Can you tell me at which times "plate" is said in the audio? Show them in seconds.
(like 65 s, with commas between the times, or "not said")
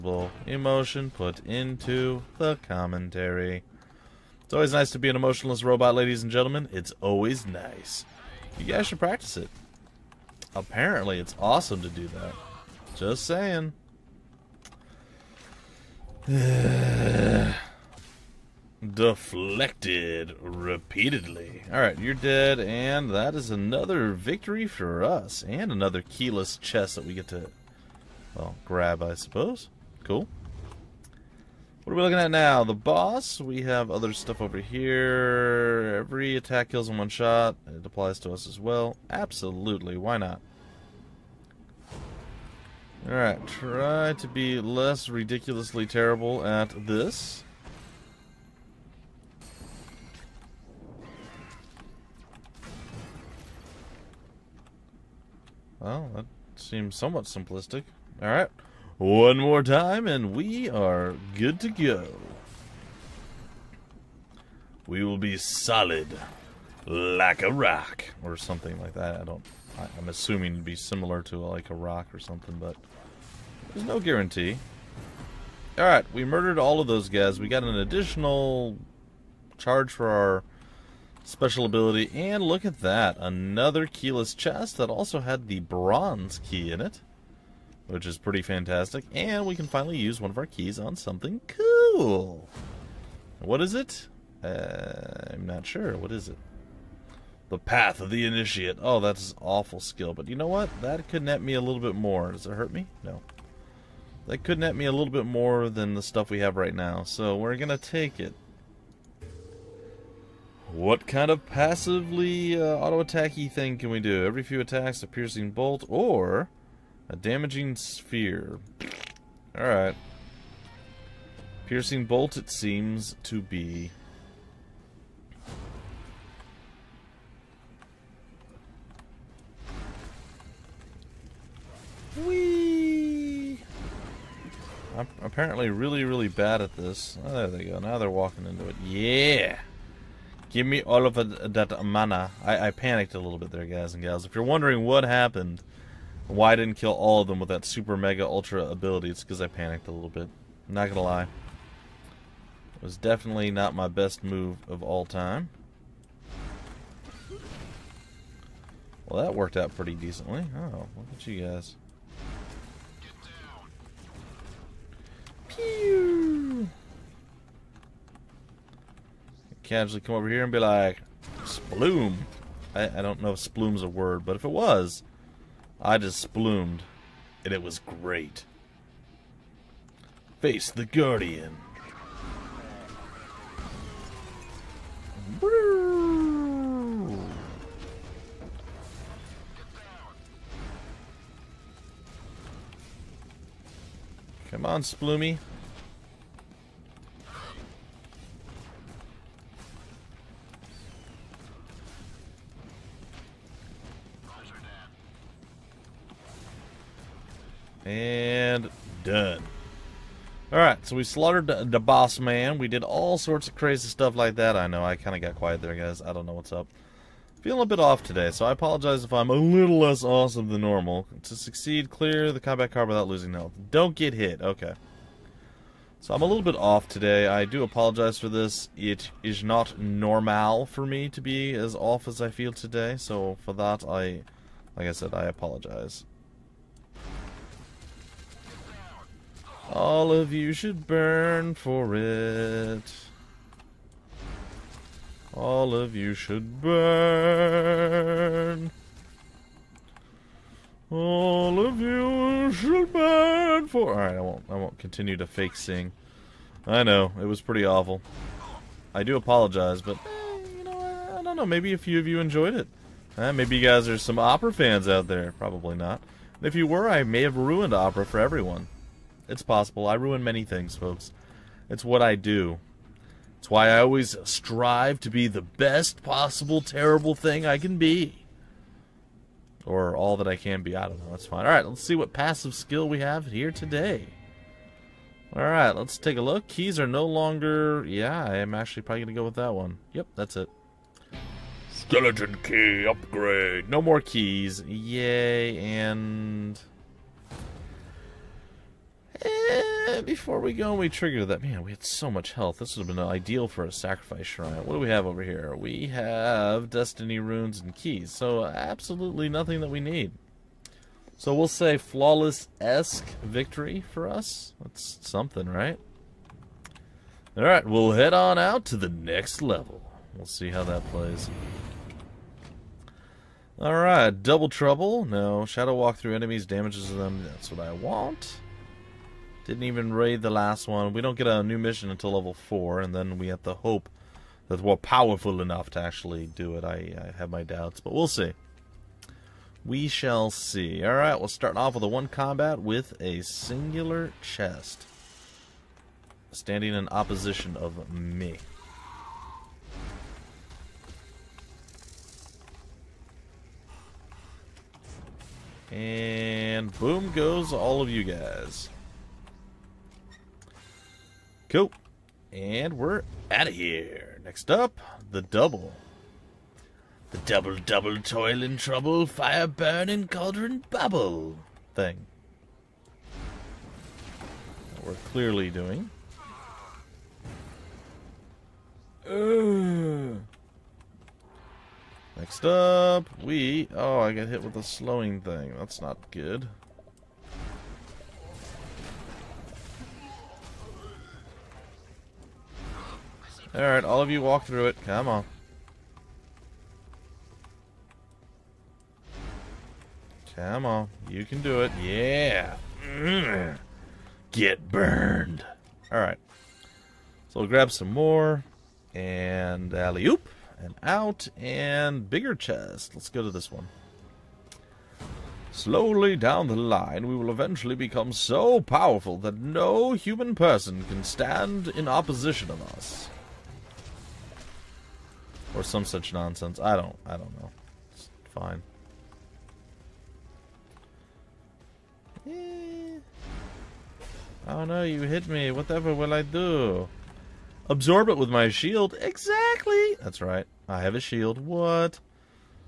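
not said.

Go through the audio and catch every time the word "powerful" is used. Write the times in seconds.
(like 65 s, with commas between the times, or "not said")
334 s, 418 s.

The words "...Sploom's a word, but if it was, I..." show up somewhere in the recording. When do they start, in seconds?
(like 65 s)
173 s.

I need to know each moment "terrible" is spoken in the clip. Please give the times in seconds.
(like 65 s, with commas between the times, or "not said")
45 s, 276 s.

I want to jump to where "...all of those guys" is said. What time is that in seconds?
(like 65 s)
76 s.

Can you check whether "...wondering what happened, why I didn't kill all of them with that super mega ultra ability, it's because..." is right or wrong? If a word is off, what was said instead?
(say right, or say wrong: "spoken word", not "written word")
right.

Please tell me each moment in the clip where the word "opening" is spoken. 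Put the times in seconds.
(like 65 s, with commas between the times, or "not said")
not said.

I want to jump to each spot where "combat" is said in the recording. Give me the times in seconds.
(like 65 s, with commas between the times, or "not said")
222 s, 342 s.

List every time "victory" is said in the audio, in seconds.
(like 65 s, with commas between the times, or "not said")
24 s, 313 s.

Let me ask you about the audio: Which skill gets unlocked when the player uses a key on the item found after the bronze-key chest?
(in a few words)
The Path of the Initiate.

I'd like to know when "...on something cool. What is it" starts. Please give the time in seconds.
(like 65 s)
90 s.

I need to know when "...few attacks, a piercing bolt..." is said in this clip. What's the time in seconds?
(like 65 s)
114 s.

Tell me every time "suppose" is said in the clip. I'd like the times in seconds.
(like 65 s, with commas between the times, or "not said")
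29 s.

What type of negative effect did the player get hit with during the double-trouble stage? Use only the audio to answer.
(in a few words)
Slowing.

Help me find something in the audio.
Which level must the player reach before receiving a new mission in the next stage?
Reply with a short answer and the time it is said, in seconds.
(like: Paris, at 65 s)
4, at 332 s.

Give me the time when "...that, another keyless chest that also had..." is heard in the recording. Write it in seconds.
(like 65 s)
82 s.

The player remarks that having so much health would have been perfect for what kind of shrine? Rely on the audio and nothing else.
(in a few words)
Sacrifice shrine.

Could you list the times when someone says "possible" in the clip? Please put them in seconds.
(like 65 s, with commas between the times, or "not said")
269 s, 276 s.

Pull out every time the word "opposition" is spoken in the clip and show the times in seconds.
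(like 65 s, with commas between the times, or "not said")
346 s, 421 s.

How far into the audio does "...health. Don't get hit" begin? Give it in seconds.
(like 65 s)
223 s.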